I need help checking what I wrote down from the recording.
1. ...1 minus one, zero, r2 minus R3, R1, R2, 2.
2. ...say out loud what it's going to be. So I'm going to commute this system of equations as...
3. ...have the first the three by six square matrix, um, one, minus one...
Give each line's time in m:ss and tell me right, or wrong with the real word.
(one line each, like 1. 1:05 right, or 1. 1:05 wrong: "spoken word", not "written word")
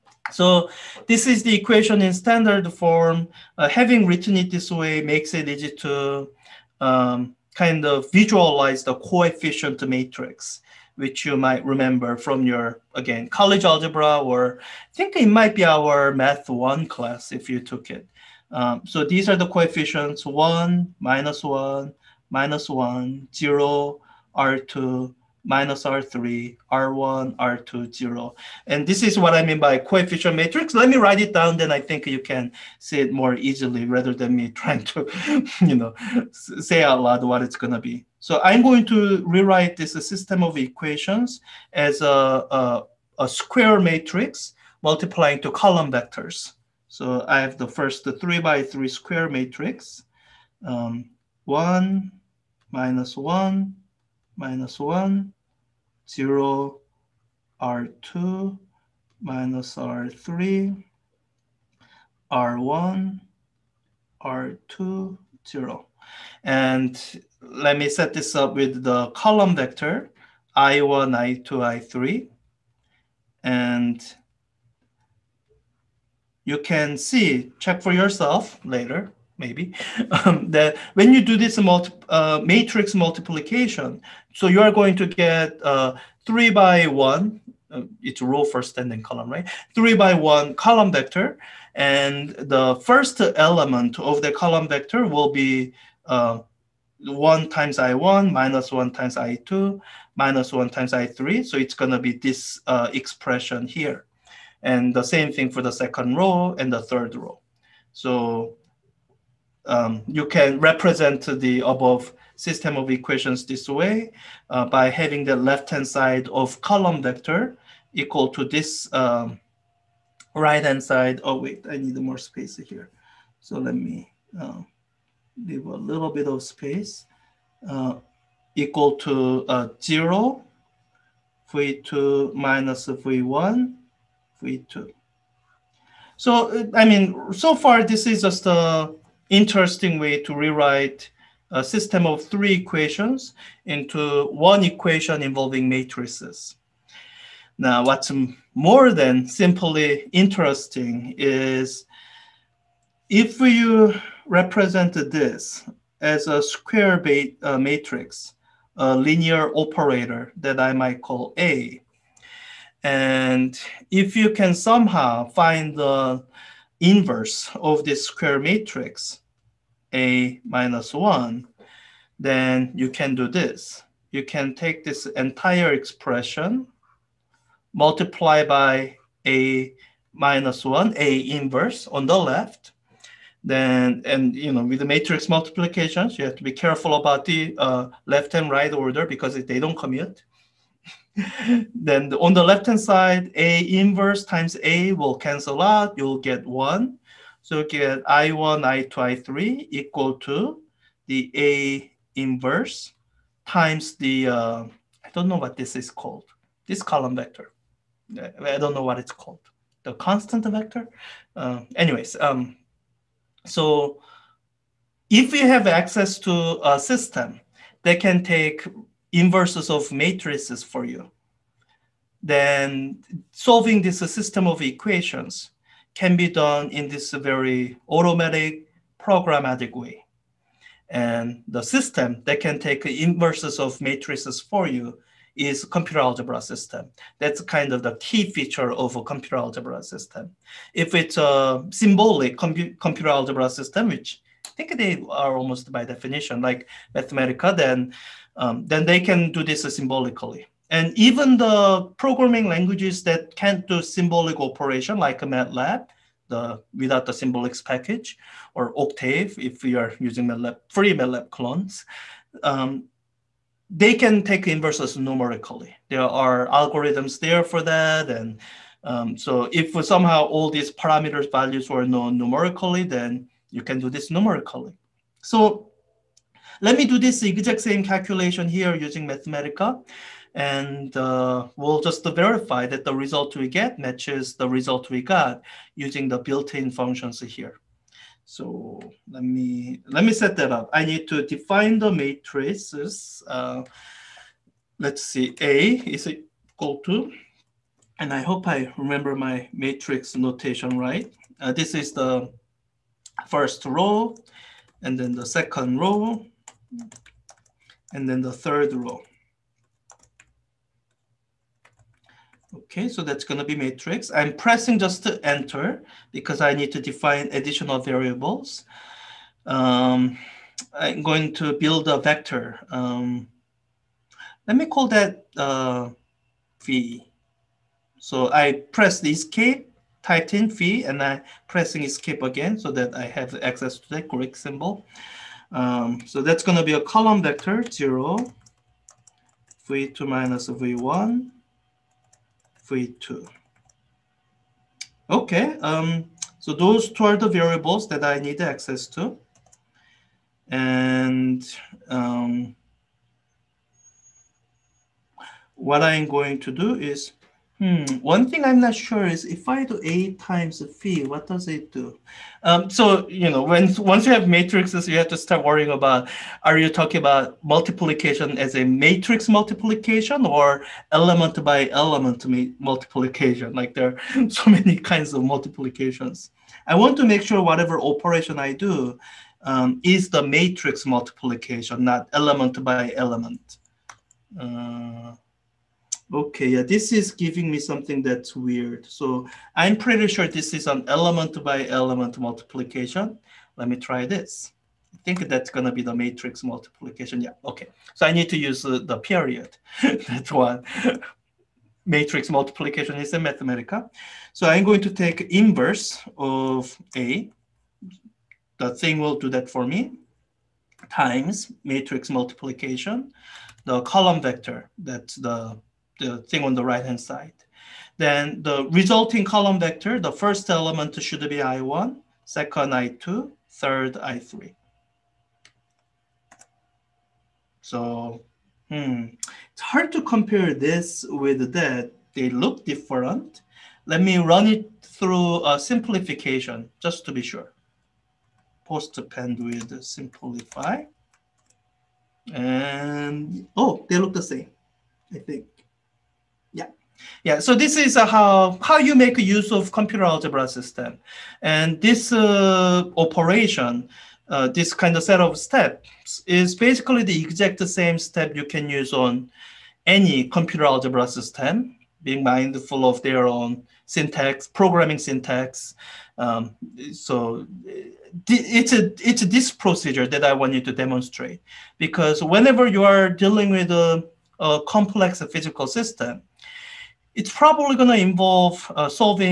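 1. 0:21 wrong: "0", not "2"
2. 0:36 wrong: "rewrite", not "commute"
3. 0:47 wrong: "three", not "six".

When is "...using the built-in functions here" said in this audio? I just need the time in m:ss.
4:45.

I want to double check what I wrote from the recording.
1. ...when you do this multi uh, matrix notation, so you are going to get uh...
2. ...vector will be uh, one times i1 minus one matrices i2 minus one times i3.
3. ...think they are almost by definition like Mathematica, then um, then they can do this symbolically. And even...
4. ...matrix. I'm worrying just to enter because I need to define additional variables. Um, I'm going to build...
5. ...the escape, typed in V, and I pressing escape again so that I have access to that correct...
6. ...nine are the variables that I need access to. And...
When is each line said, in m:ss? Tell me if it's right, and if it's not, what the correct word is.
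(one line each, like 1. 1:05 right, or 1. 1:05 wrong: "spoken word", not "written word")
1. 1:20 wrong: "multiplication", not "notation"
2. 1:34 wrong: "times", not "matrices"
3. 4:04 right
4. 5:13 wrong: "pressing", not "worrying"
5. 5:29 right
6. 5:46 wrong: "two", not "nine".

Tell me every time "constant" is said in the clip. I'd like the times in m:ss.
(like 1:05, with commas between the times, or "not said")
3:29.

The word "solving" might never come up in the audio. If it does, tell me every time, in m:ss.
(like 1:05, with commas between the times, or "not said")
3:43.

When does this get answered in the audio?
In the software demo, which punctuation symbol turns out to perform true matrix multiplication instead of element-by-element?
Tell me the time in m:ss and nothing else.
6:38.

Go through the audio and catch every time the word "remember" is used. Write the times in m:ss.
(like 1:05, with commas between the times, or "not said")
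0:11, 4:58.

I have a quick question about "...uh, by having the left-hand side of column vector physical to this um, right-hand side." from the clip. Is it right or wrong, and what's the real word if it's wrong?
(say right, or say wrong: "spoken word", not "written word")
wrong: "equal", not "physical".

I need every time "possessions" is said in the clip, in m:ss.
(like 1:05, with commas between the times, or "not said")
not said.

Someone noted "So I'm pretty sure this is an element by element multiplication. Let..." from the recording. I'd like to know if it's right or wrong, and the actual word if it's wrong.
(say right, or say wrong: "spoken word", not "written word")
right.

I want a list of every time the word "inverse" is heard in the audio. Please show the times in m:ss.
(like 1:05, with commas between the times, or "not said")
2:46, 3:01, 3:13, 3:22, 3:39, 3:52, 4:24, 6:45.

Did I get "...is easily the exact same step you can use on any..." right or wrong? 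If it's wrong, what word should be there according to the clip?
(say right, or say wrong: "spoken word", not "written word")
wrong: "basically", not "easily".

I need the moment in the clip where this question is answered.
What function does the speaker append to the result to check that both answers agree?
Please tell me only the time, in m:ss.
7:19.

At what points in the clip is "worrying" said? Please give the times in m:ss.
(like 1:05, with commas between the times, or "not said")
6:05.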